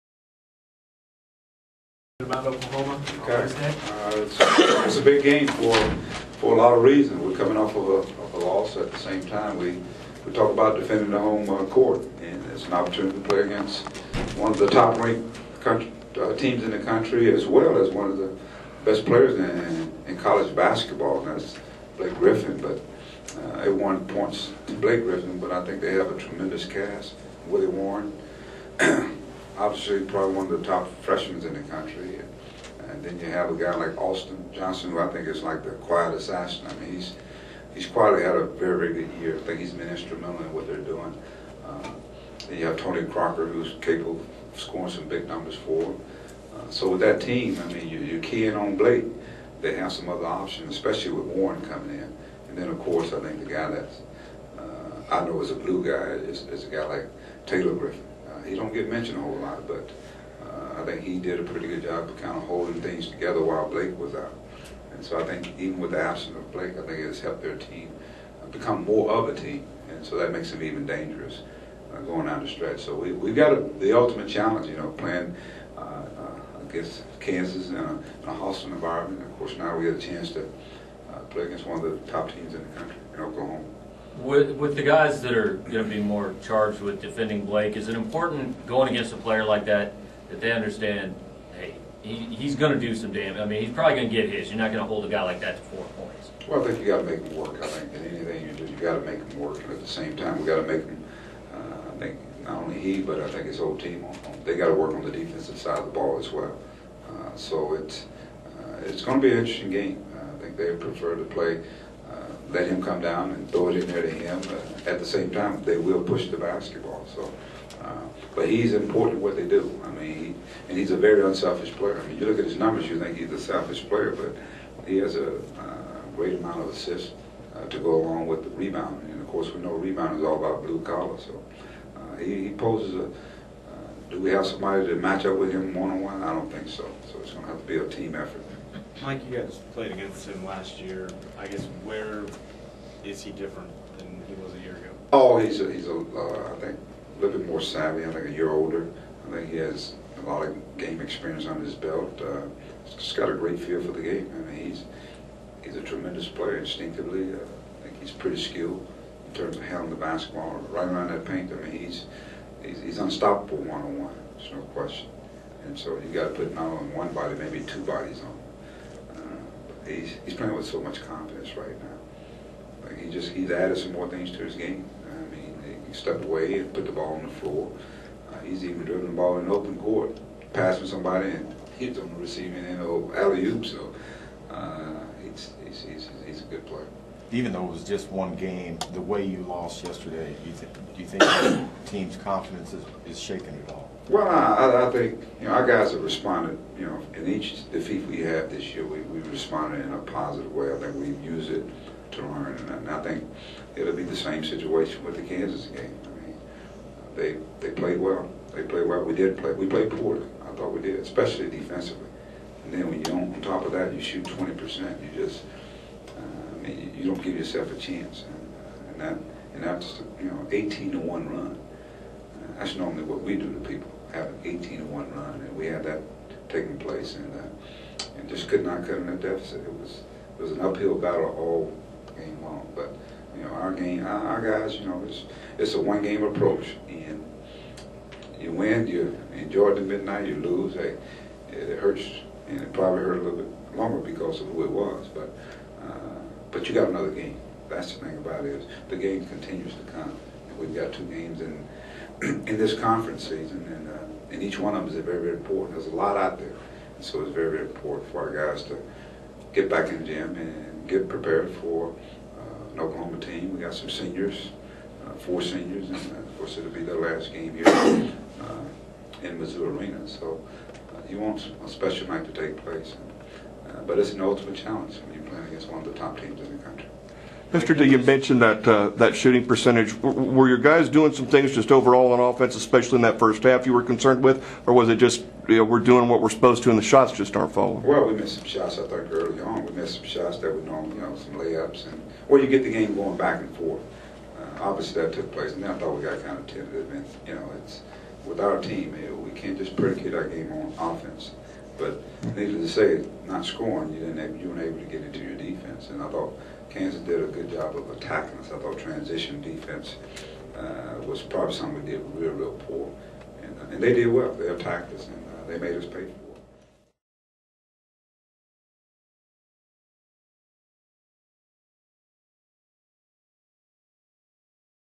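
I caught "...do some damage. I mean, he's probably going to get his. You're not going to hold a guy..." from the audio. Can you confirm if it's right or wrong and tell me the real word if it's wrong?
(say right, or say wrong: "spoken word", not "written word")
right.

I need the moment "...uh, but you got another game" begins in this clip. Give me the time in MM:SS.
04:05.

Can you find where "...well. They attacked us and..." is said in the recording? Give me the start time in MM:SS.
05:14.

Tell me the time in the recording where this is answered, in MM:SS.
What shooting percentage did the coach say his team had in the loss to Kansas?
03:34.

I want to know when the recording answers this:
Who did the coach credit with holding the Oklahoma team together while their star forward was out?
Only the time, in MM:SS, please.
00:57.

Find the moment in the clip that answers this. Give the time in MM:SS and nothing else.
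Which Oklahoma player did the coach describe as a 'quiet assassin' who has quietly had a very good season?
00:33.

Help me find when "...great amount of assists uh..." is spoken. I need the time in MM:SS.
02:06.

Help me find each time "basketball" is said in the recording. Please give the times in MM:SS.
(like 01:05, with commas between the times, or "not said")
00:20, 01:56, 02:39.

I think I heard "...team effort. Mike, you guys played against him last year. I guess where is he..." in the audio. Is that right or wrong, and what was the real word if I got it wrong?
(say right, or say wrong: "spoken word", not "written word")
right.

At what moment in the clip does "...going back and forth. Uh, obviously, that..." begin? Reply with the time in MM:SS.
04:52.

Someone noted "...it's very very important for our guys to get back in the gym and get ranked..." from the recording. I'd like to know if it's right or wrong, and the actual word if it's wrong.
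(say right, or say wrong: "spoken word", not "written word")
wrong: "prepared", not "ranked".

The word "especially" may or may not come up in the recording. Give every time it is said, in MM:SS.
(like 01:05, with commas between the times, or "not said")
00:50, 03:30, 04:42.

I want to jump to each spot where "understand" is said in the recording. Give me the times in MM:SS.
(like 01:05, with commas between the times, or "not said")
01:30.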